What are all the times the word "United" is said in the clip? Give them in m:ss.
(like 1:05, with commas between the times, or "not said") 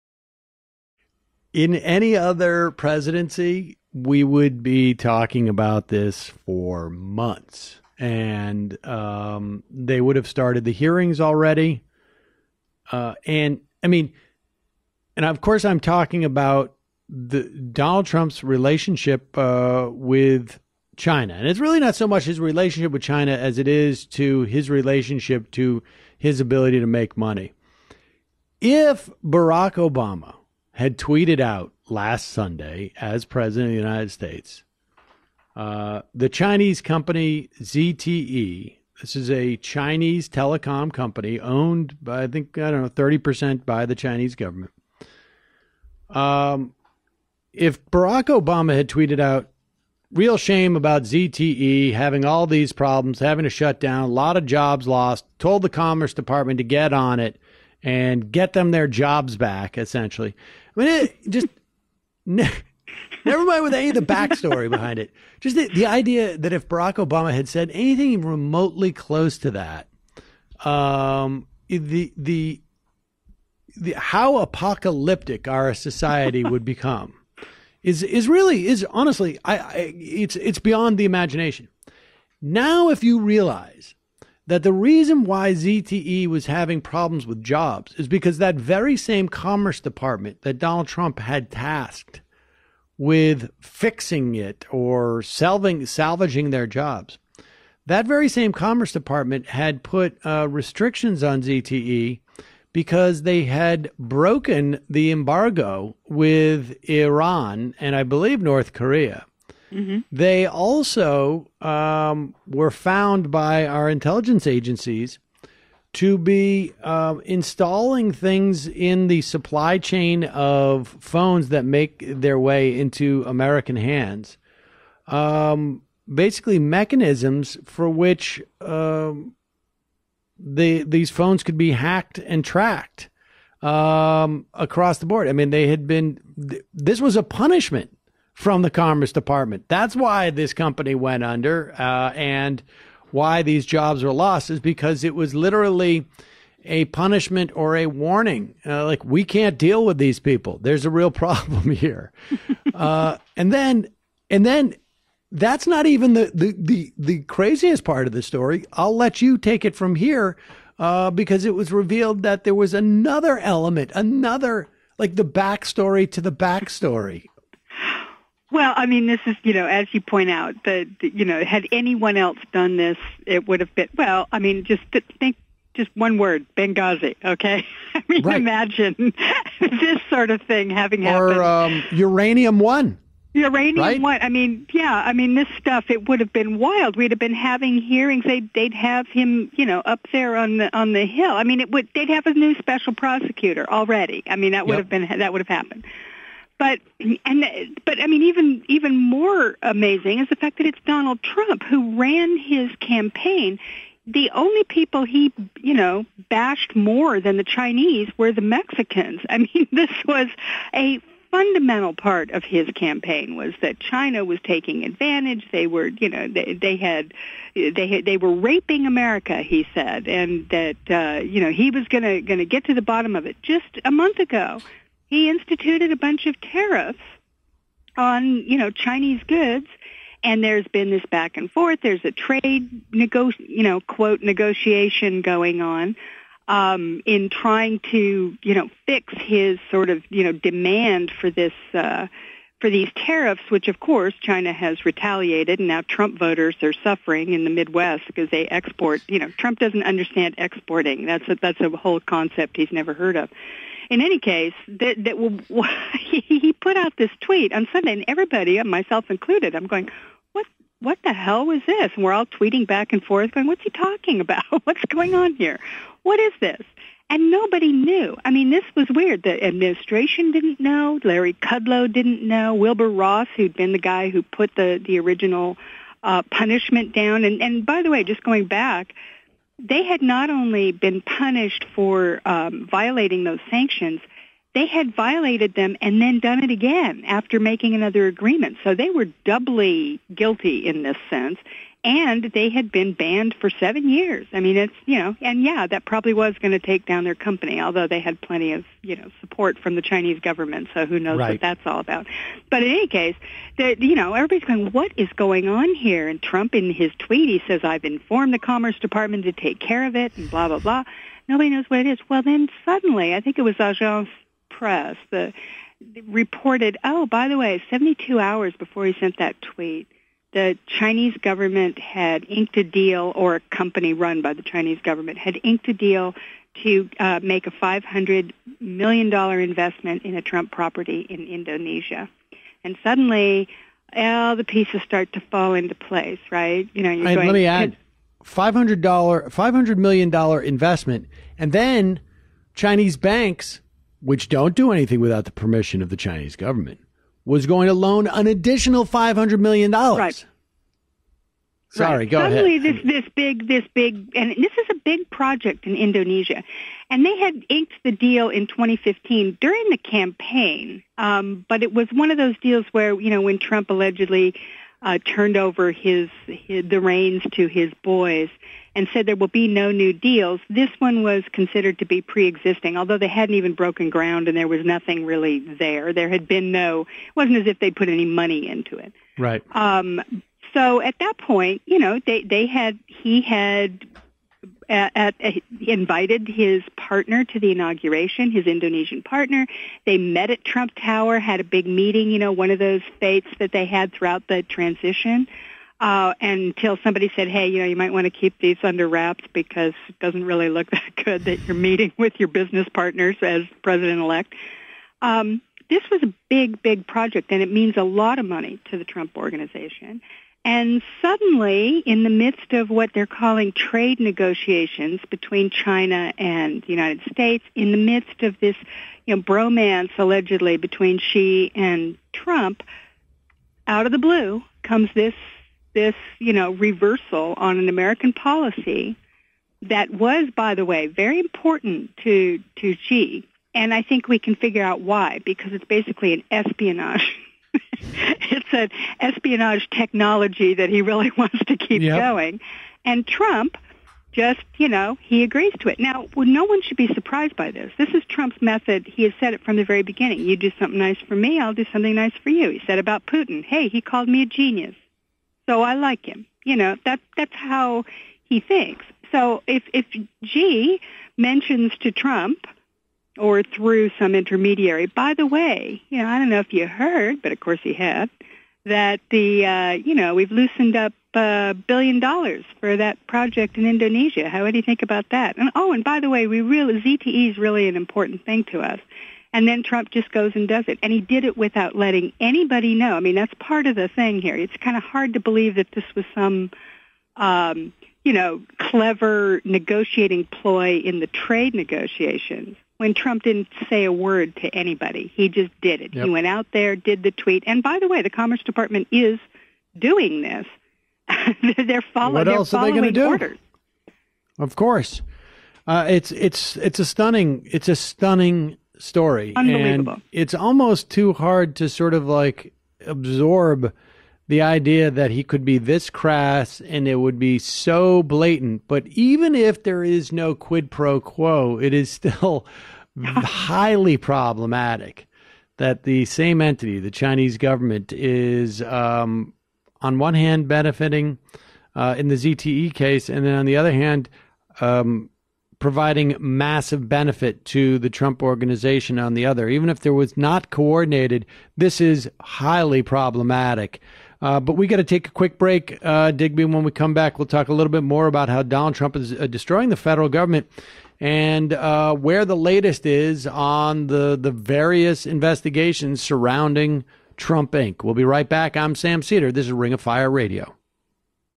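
0:33, 6:56.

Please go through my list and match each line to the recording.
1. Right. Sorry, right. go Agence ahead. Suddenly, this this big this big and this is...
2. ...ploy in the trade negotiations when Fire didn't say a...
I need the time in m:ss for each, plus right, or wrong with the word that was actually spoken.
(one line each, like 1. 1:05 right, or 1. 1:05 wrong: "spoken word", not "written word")
1. 5:49 wrong: "Suddenly", not "Agence"
2. 8:10 wrong: "Trump", not "Fire".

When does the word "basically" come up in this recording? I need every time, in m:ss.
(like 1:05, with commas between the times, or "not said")
2:06, 7:15.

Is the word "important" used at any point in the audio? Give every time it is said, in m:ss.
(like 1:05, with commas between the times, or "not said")
7:11, 7:57.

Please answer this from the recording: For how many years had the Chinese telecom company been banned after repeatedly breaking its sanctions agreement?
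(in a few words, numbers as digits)
7.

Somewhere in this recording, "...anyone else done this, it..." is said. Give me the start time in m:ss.
2:51.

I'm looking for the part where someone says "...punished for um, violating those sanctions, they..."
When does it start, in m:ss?
4:41.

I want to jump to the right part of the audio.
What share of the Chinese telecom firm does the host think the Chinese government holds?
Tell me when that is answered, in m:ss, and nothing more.
0:42.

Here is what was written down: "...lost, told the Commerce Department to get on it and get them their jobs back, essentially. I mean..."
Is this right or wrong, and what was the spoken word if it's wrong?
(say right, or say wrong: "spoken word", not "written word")
right.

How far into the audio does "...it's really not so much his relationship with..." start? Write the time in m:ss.
0:21.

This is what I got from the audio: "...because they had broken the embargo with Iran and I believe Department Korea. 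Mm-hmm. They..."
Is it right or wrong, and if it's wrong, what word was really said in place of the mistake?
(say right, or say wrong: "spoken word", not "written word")
wrong: "North", not "Department".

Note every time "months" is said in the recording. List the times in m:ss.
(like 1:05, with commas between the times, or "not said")
0:06, 3:43.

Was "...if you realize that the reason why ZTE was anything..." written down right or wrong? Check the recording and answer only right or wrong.
wrong.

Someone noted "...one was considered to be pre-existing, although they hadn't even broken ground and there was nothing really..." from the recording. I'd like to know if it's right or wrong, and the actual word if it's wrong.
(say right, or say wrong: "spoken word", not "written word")
right.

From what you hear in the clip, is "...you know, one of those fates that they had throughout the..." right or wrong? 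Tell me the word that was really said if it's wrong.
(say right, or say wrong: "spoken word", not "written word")
right.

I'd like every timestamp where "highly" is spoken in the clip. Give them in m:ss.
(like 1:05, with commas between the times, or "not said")
8:43, 9:02.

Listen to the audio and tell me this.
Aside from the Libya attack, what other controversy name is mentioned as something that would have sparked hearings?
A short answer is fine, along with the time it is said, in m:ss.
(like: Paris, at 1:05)
Uranium One, at 3:01.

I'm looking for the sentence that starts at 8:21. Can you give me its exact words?
they're, follow- what else they're following are they do?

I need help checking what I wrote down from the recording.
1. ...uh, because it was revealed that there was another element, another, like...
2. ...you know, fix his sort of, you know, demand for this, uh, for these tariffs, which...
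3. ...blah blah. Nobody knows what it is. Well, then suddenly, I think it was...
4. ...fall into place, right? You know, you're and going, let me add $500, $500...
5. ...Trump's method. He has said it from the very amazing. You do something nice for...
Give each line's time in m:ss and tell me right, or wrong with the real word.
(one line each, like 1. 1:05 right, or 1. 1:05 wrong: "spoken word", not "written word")
1. 2:40 right
2. 3:58 right
3. 5:10 right
4. 5:35 right
5. 7:28 wrong: "beginning", not "amazing".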